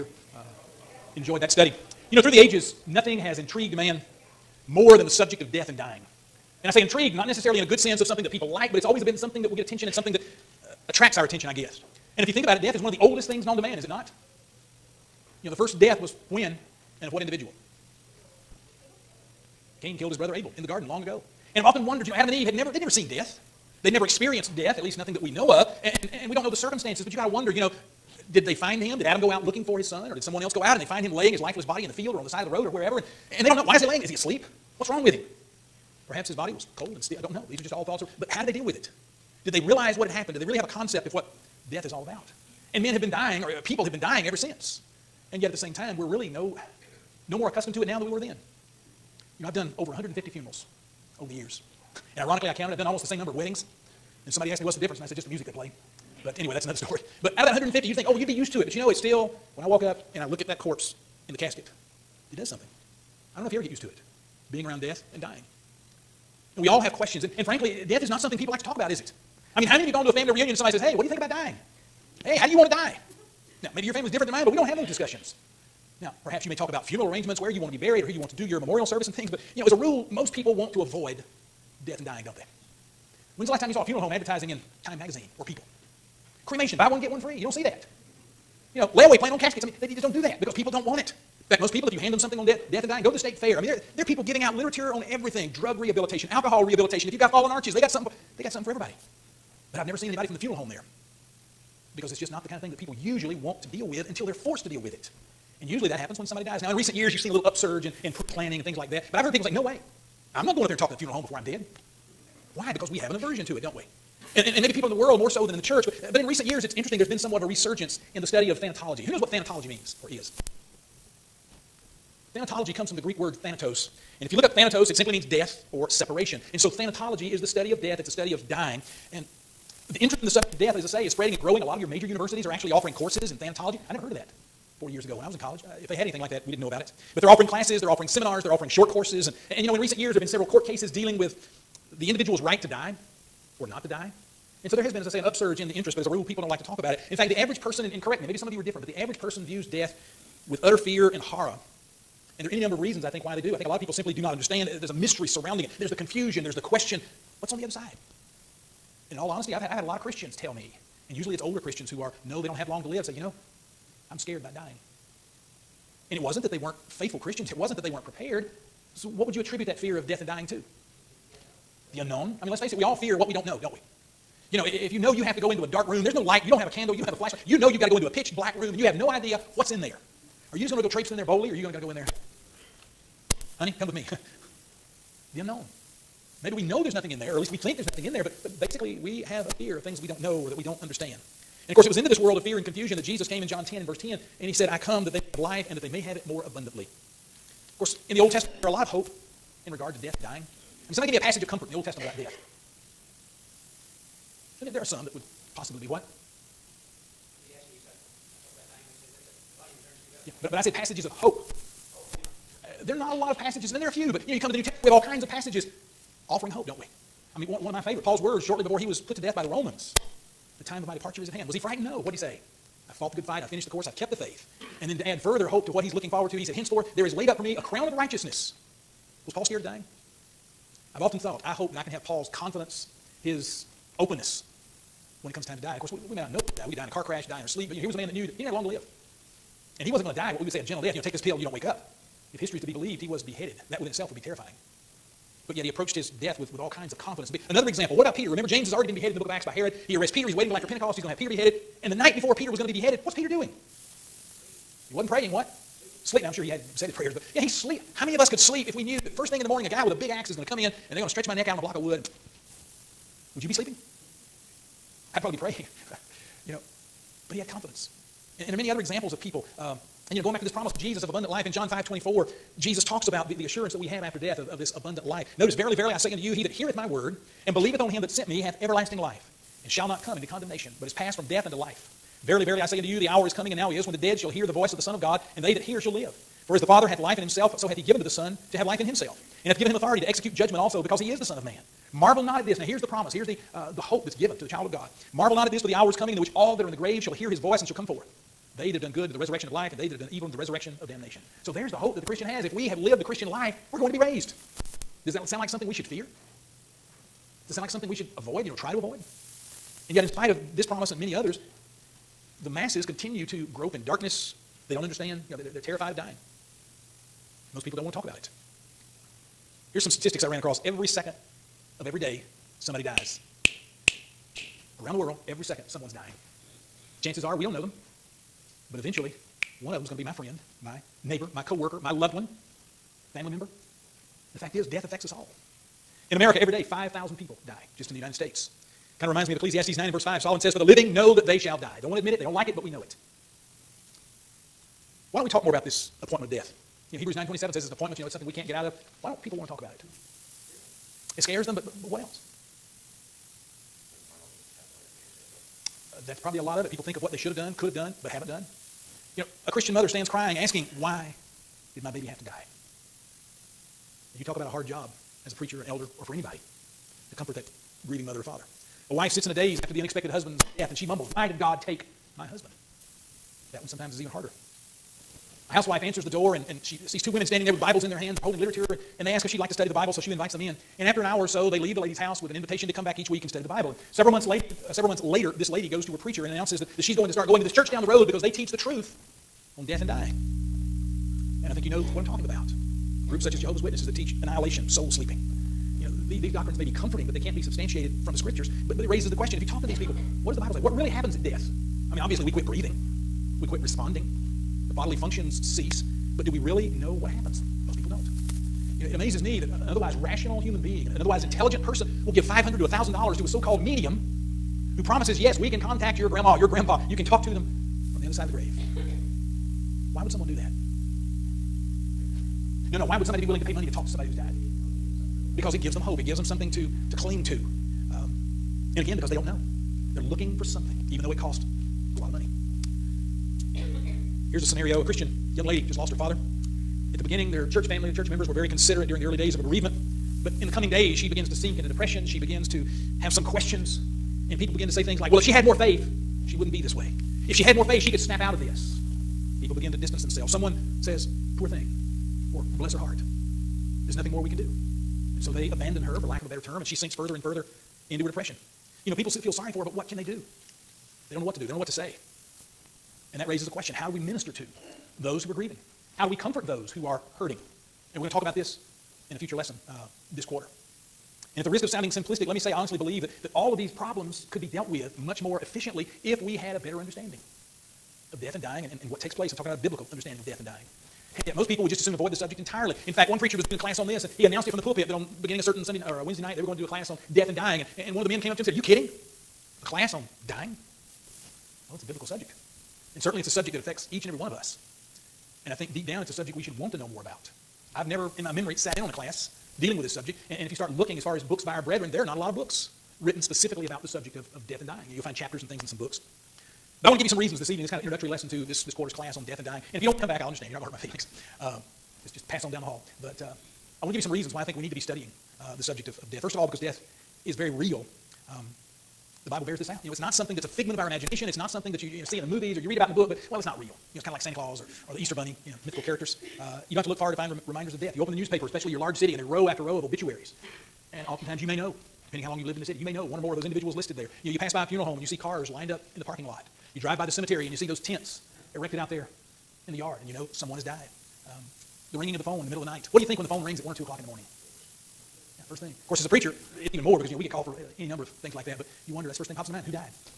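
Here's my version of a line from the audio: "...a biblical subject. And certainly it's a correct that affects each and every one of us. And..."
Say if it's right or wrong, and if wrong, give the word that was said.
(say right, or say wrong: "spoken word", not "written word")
wrong: "subject", not "correct".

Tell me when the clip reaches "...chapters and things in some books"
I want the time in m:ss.
8:25.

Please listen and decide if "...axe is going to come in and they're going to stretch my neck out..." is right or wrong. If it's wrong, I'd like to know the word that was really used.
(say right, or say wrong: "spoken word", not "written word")
right.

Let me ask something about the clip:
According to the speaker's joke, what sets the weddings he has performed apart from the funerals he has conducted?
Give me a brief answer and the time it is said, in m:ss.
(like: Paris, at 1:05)
The music they play, at 0:55.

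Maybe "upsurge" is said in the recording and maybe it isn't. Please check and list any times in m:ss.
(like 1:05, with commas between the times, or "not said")
1:47, 2:25.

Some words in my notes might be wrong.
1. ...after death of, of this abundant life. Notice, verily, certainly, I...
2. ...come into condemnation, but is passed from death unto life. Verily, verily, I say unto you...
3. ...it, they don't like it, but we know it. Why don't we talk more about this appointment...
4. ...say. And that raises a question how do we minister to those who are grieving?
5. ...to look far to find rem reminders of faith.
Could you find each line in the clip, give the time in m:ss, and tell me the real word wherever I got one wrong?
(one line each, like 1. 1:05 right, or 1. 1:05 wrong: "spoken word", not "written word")
1. 4:34 wrong: "verily", not "certainly"
2. 4:40 right
3. 5:42 right
4. 7:41 right
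5. 8:46 wrong: "death", not "faith".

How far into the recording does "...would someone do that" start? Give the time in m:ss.
7:00.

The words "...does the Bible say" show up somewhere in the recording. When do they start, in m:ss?
6:40.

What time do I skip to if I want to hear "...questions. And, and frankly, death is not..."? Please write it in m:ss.
1:06.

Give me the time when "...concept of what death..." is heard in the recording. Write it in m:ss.
0:40.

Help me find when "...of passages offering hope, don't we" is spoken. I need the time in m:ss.
3:35.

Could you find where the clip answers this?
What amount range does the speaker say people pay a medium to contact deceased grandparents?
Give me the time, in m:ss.
6:52.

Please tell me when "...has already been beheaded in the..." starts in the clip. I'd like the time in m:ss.
4:08.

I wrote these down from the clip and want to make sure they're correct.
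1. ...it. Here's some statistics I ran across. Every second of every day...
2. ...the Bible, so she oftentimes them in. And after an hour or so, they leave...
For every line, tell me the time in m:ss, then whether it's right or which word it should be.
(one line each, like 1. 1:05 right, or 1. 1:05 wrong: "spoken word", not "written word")
1. 5:18 right
2. 6:19 wrong: "invites", not "oftentimes".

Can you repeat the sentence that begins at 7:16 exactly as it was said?
At the beginning, their church family, the church members were very considerate during the early days of a bereavement.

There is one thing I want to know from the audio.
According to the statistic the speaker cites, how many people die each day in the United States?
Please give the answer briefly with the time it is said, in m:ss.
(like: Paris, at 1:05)
5,000, at 5:36.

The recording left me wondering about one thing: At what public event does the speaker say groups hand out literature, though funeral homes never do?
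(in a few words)
The state fair.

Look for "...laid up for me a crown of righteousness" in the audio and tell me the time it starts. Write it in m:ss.
3:47.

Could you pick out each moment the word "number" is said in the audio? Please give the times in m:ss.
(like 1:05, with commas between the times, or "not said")
0:53, 2:32, 9:07.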